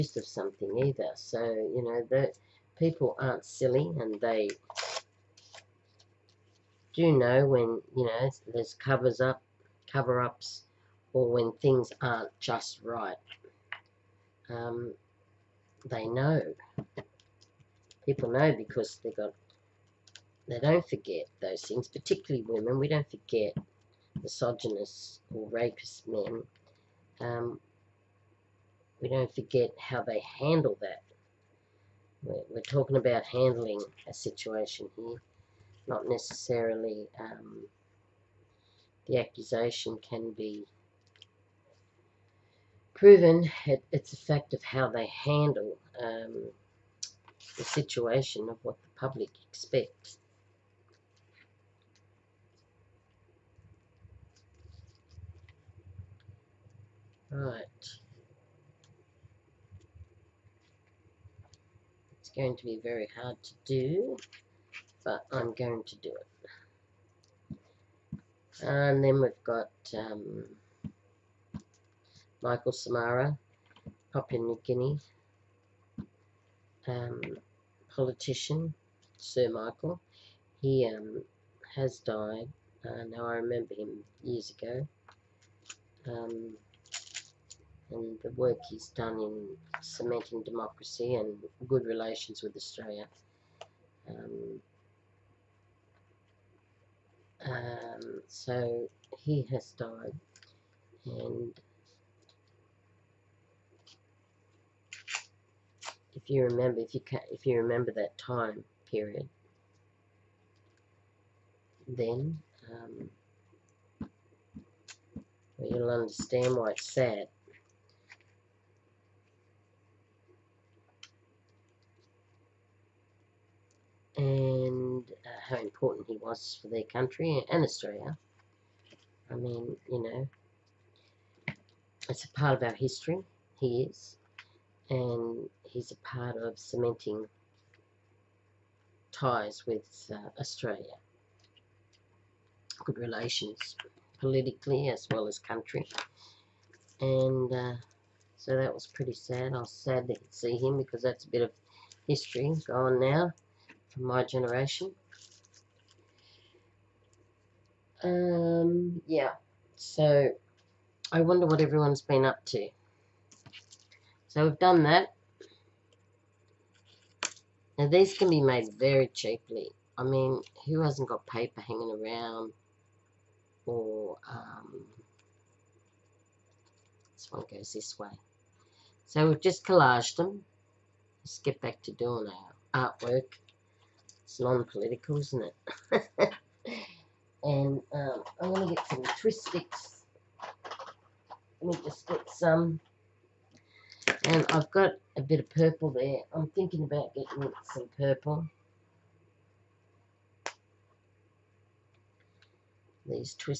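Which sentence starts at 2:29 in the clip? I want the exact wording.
I was sad to see him because that's a bit of history gone now from my generation.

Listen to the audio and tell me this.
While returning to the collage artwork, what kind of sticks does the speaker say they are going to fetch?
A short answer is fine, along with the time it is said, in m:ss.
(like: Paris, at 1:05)
twist sticks, at 3:09.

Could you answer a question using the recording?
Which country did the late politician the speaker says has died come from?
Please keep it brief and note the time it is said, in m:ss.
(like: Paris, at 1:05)
Papua New Guinea, at 1:14.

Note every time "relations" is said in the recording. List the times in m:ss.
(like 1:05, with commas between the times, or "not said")
1:31, 2:22.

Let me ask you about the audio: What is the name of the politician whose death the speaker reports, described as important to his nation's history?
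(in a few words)
Michael Somare.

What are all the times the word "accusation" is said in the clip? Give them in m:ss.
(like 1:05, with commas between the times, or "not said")
0:39.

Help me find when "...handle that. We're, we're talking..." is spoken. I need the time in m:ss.
0:30.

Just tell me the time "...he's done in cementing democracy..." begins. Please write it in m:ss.
1:28.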